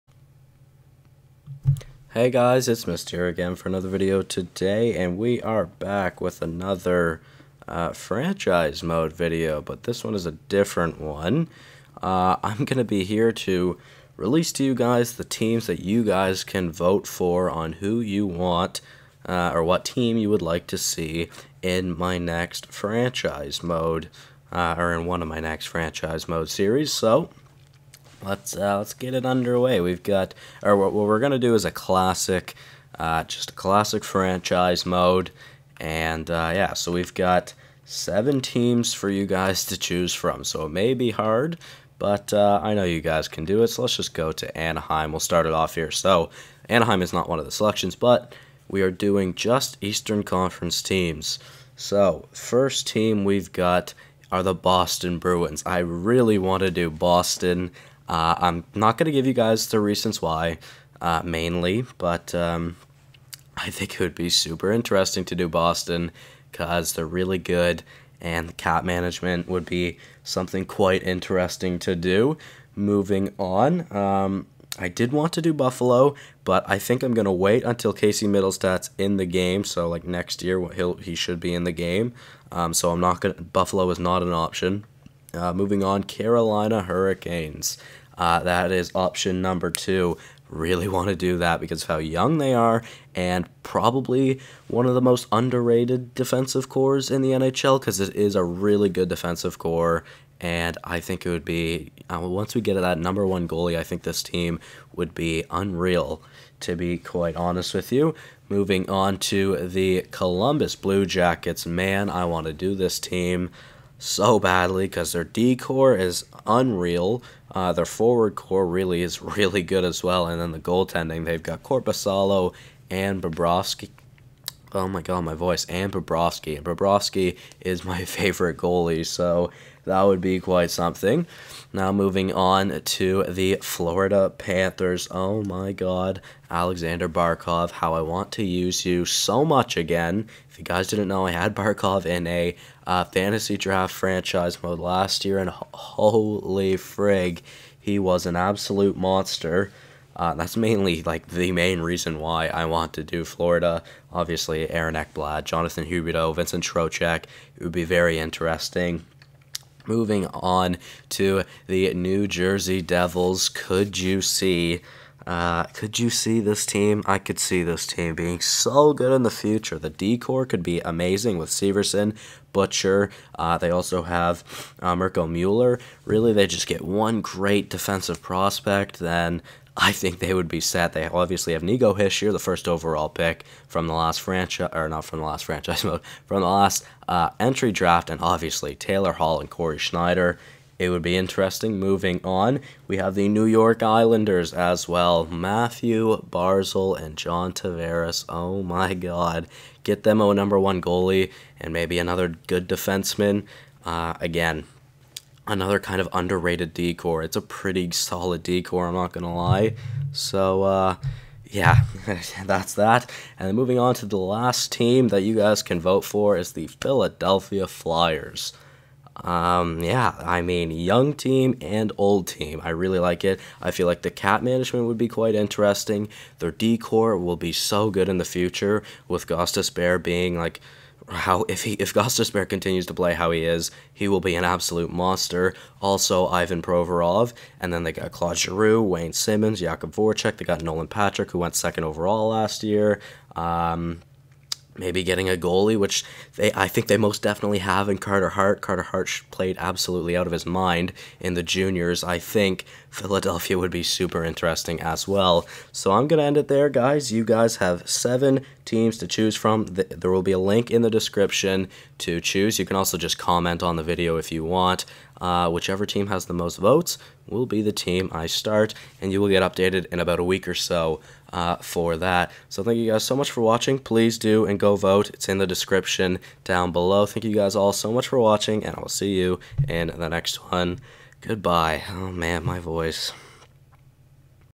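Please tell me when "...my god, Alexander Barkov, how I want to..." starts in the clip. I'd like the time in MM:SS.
02:15.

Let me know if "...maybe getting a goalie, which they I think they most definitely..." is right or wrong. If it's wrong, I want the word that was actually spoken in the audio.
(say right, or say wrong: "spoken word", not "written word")
right.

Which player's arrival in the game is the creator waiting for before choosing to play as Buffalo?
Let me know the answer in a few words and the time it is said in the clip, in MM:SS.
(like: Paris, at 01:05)
Casey Mittelstadt, at 01:17.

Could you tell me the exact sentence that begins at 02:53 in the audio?
Uh, they also have uh, Mirco Mueller.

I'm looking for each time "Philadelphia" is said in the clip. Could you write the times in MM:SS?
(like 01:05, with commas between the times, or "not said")
03:36, 04:12.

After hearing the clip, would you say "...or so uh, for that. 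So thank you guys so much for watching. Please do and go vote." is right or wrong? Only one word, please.
right.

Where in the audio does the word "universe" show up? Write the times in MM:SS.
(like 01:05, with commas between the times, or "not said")
not said.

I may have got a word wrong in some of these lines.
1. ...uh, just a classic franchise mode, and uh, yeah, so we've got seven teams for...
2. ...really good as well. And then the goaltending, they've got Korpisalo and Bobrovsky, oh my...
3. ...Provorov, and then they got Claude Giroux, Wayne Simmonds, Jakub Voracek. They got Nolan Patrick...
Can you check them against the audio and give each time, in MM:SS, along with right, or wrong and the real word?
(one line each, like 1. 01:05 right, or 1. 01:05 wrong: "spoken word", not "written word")
1. 00:32 right
2. 01:59 right
3. 03:56 right.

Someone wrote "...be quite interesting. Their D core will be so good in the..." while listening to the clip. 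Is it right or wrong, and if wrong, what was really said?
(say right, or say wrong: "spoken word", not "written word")
right.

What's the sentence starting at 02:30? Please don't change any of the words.
Uh, that's mainly like the main reason why I want to do Florida.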